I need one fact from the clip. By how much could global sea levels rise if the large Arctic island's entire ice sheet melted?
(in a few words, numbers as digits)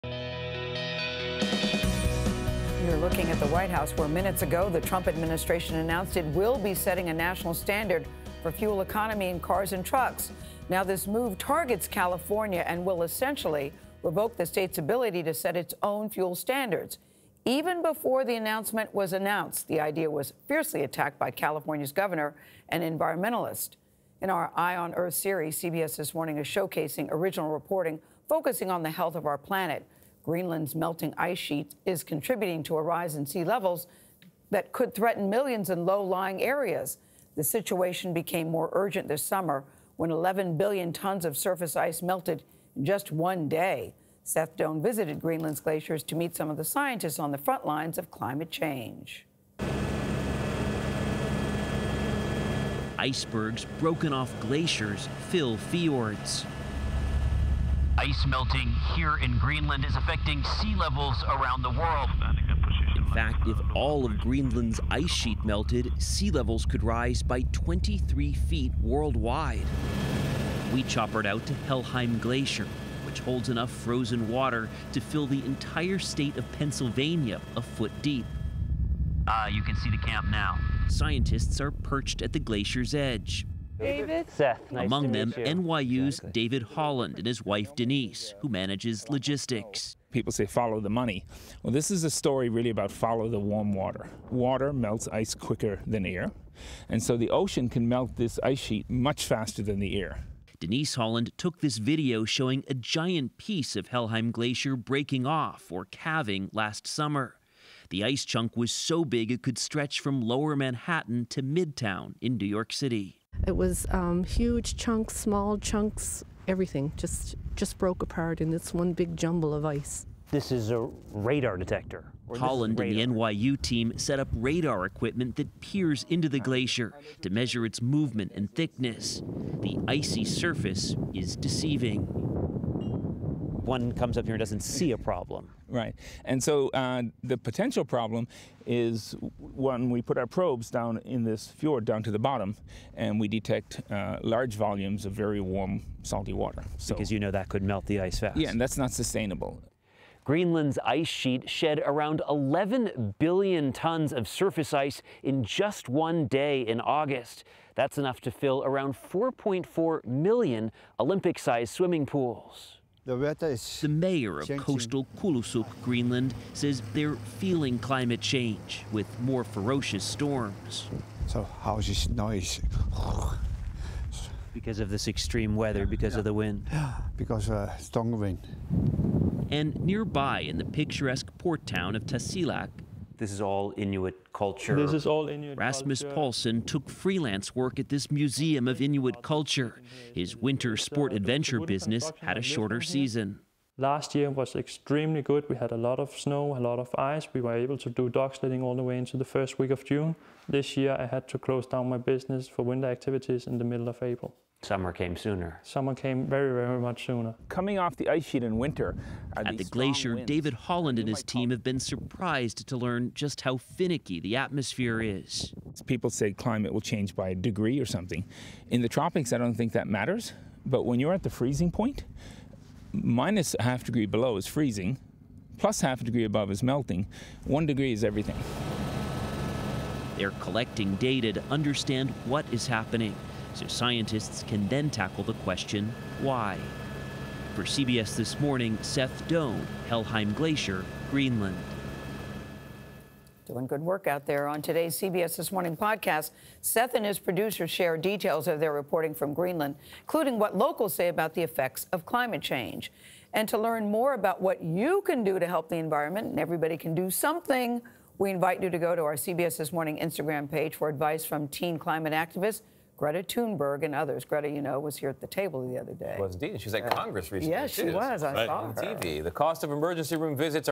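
23 feet.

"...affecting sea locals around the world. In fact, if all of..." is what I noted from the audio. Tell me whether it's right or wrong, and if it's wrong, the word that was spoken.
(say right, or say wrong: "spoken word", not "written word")
wrong: "levels", not "locals".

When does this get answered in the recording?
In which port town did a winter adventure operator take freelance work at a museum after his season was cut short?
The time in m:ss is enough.
3:02.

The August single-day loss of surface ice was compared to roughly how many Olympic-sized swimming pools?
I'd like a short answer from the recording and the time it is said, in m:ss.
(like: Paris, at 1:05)
4.4 million, at 2:38.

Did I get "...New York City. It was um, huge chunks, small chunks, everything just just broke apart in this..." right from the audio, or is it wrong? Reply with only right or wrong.
right.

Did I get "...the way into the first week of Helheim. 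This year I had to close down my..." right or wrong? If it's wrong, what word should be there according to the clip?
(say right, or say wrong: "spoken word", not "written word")
wrong: "June", not "Helheim".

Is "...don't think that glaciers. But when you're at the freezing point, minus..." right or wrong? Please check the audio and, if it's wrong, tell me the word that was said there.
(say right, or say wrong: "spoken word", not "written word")
wrong: "matters", not "glaciers".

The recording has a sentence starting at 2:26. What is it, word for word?
So, because you know that could melt the ice fast.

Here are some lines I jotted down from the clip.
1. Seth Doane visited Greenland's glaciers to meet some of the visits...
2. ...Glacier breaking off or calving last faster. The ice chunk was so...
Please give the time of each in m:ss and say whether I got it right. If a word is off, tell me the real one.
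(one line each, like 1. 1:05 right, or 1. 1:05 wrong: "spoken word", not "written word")
1. 0:44 wrong: "scientists", not "visits"
2. 1:44 wrong: "summer", not "faster".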